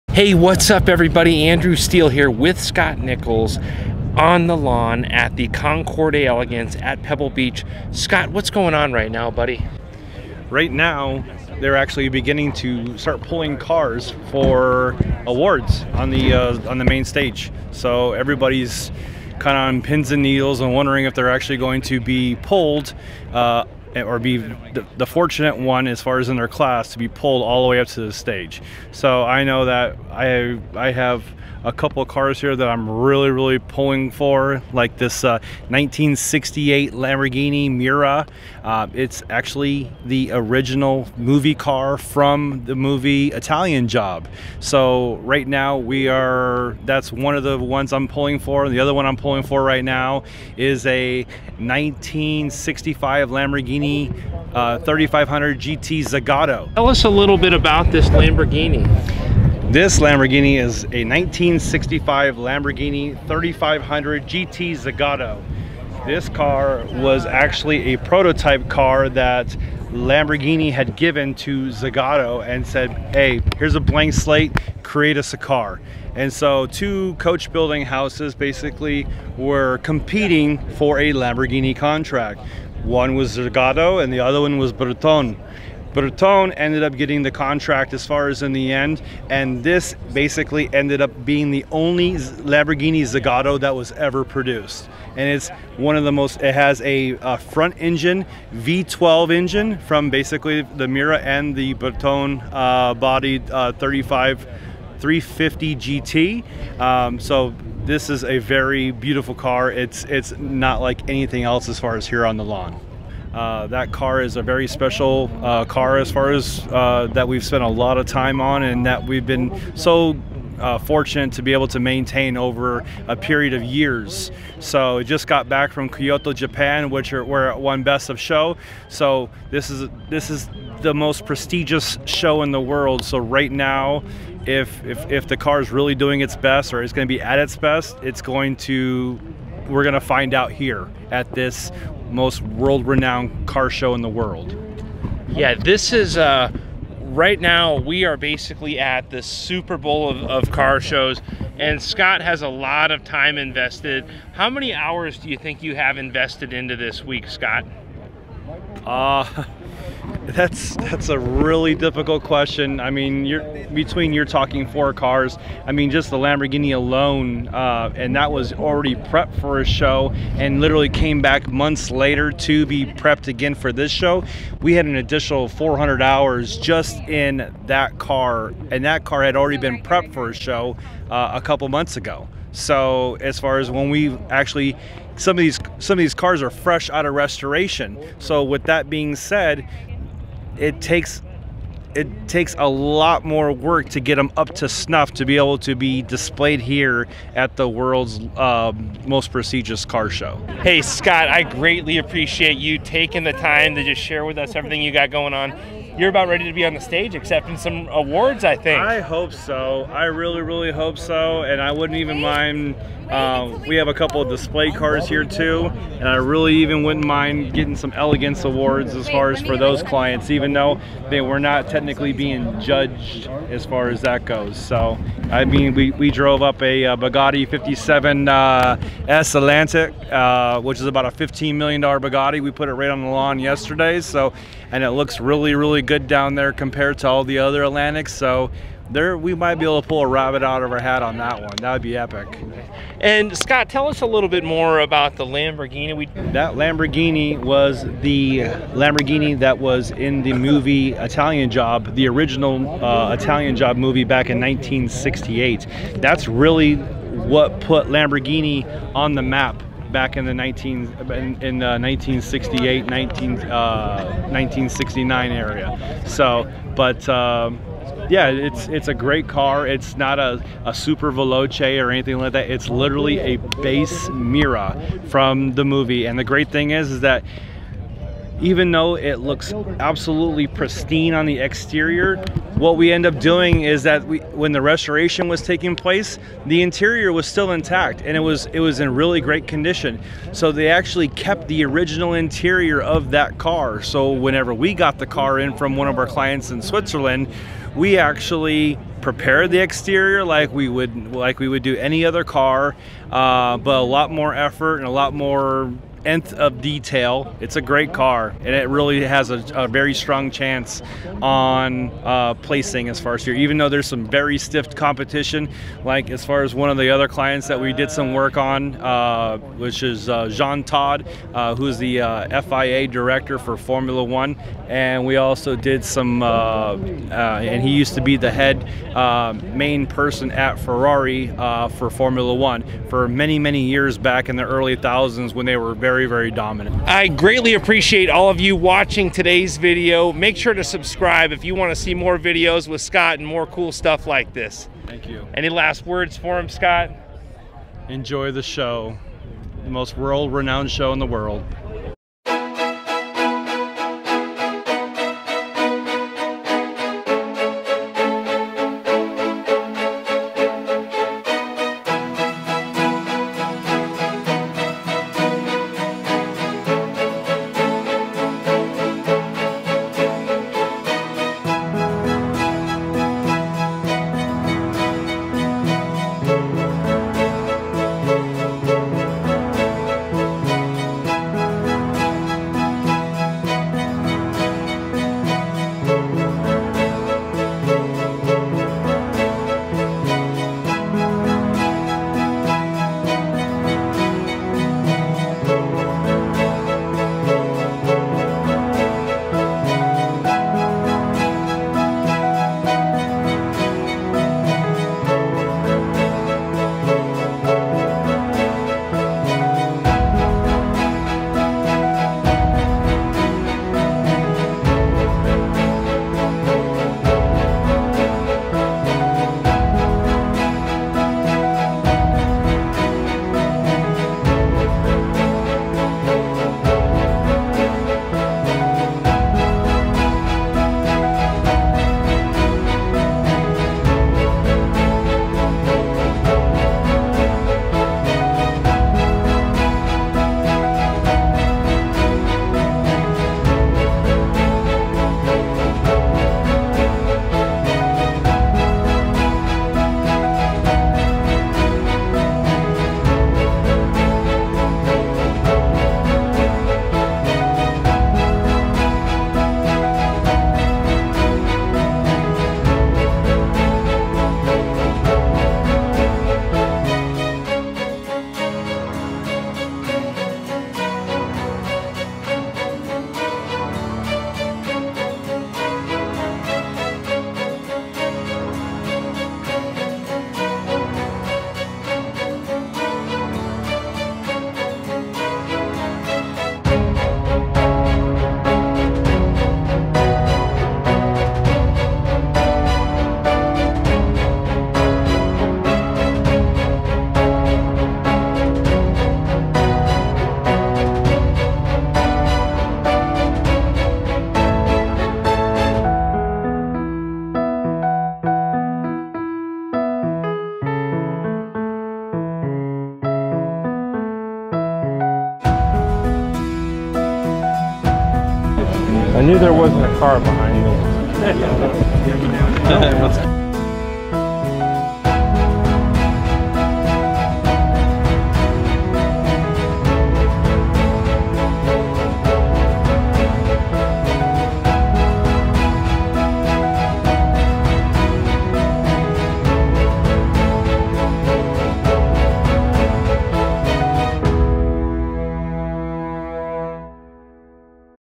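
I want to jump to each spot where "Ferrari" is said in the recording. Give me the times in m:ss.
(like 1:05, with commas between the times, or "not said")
5:30.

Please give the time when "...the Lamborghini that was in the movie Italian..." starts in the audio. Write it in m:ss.
4:08.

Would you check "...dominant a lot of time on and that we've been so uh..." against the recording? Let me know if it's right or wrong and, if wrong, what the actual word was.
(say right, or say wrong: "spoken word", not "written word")
wrong: "spent", not "dominant".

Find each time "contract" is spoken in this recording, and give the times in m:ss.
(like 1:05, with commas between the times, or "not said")
1:21, 1:27.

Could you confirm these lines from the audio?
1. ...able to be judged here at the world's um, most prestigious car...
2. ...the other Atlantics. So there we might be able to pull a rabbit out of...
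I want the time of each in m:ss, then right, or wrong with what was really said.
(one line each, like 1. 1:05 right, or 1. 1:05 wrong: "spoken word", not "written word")
1. 3:15 wrong: "displayed", not "judged"
2. 3:57 right.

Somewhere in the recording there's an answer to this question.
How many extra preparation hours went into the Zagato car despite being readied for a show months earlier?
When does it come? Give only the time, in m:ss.
2:55.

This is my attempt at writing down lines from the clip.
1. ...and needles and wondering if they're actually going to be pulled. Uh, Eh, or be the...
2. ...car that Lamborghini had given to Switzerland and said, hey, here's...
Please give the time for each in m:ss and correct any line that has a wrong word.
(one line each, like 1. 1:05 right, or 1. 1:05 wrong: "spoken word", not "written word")
1. 0:20 right
2. 1:08 wrong: "Zagato", not "Switzerland".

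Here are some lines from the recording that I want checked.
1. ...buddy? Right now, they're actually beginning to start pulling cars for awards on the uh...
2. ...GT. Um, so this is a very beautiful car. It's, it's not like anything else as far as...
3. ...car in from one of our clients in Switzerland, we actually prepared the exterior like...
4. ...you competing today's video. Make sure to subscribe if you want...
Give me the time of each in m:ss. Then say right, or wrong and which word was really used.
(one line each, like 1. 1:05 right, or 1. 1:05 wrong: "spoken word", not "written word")
1. 0:09 right
2. 1:45 right
3. 4:55 right
4. 5:38 wrong: "watching", not "competing".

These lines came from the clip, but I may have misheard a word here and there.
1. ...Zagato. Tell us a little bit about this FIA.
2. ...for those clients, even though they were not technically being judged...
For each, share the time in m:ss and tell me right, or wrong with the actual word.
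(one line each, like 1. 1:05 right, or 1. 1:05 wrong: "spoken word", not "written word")
1. 0:56 wrong: "Lamborghini", not "FIA"
2. 3:39 right.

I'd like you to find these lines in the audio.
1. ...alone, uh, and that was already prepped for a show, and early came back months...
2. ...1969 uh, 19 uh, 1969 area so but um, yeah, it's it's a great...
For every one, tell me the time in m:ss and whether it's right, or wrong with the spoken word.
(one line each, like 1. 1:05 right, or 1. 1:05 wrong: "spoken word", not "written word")
1. 2:46 wrong: "literally", not "early"
2. 4:21 wrong: "1968", not "1969".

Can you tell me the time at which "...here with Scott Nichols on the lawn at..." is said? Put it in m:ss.
0:02.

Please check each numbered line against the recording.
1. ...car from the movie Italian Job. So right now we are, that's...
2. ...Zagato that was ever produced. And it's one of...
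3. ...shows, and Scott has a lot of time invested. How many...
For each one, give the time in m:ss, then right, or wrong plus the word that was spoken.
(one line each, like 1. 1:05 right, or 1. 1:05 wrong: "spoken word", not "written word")
1. 0:41 right
2. 1:33 right
3. 2:30 right.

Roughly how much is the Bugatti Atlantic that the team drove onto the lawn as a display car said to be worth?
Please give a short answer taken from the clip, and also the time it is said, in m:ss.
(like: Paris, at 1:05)
$15 million, at 3:51.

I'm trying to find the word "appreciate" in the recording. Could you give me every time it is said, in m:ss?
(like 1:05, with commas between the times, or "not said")
3:21, 5:37.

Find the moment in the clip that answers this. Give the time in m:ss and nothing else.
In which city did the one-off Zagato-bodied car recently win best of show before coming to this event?
2:05.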